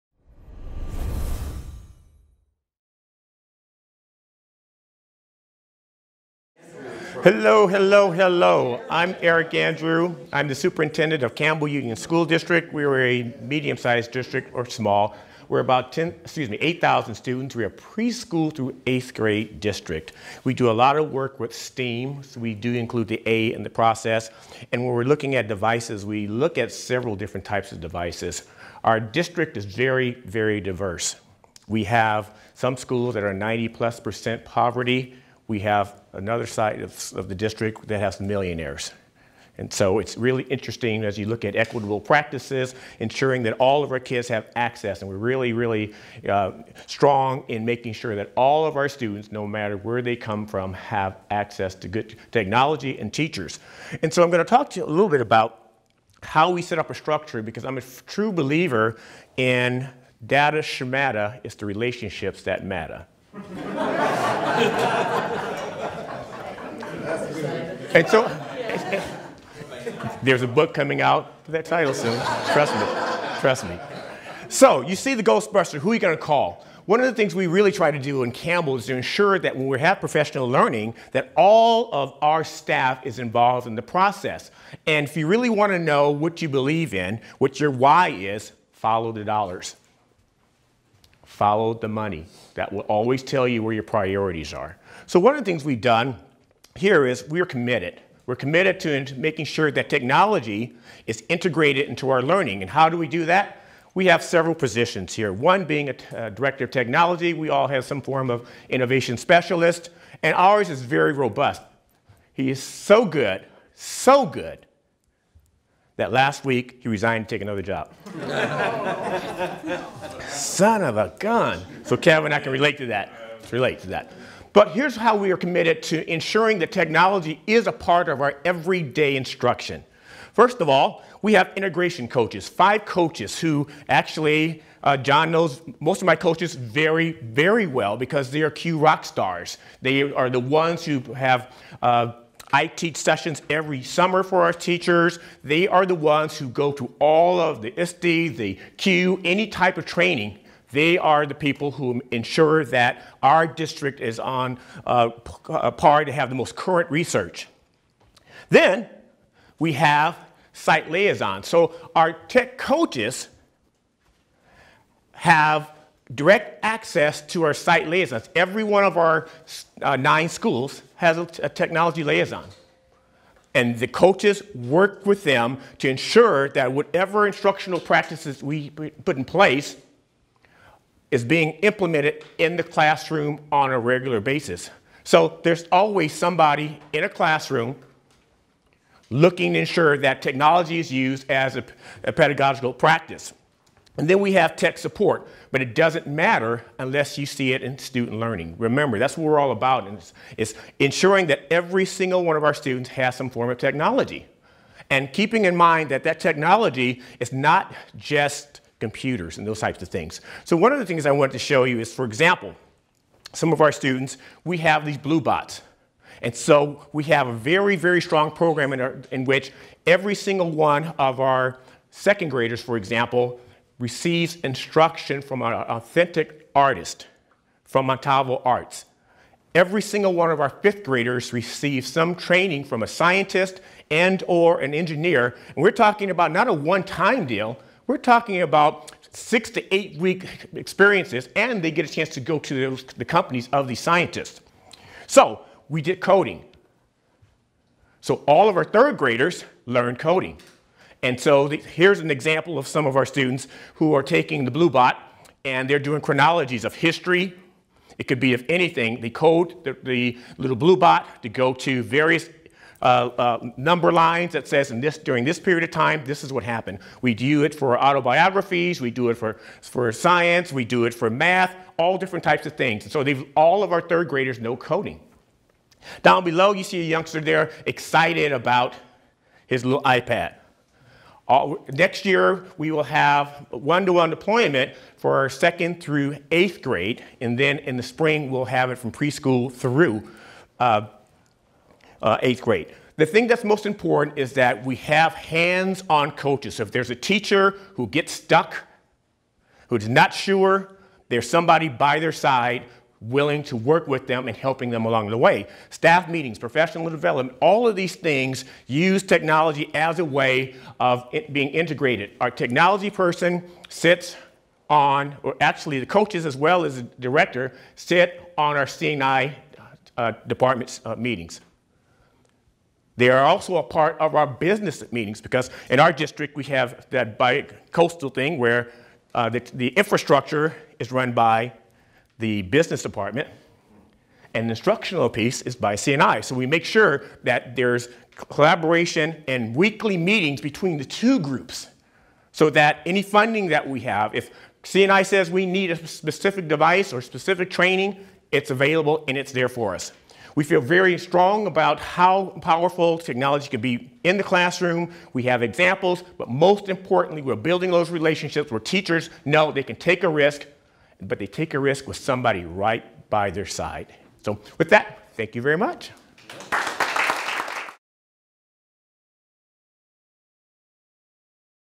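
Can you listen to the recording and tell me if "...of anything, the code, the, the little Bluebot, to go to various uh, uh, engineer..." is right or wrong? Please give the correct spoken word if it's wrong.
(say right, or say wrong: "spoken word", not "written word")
wrong: "number", not "engineer".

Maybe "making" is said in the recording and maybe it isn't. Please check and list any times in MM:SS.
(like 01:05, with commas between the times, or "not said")
00:47, 01:39.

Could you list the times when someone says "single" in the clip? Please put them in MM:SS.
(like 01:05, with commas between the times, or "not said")
03:21, 03:40, 03:49.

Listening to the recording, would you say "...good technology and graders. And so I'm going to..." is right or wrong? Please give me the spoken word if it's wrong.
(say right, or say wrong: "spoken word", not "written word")
wrong: "teachers", not "graders".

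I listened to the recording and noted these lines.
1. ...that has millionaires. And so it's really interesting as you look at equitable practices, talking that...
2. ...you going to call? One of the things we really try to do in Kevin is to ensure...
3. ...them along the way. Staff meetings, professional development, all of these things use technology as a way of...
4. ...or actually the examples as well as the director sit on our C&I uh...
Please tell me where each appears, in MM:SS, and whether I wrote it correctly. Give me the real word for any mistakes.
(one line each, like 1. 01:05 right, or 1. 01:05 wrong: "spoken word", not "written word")
1. 00:37 wrong: "ensuring", not "talking"
2. 01:15 wrong: "Campbell", not "Kevin"
3. 05:04 right
4. 05:15 wrong: "coaches", not "examples".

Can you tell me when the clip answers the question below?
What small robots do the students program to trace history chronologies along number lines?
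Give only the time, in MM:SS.
03:34.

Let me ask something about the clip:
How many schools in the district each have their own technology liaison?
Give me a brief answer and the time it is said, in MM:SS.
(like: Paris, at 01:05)
9, at 02:49.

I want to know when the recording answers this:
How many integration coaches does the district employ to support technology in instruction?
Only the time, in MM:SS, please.
02:12.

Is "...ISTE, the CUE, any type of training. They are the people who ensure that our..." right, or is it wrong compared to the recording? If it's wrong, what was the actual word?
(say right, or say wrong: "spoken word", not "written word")
right.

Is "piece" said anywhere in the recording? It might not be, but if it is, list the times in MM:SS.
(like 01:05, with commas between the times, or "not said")
05:35.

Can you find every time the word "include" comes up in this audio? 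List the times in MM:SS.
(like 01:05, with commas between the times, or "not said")
00:22.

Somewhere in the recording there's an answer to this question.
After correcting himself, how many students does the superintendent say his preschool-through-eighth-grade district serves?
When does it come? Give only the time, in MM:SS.
00:16.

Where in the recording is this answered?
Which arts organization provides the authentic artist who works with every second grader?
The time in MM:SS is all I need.
03:47.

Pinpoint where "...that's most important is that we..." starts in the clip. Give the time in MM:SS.
04:53.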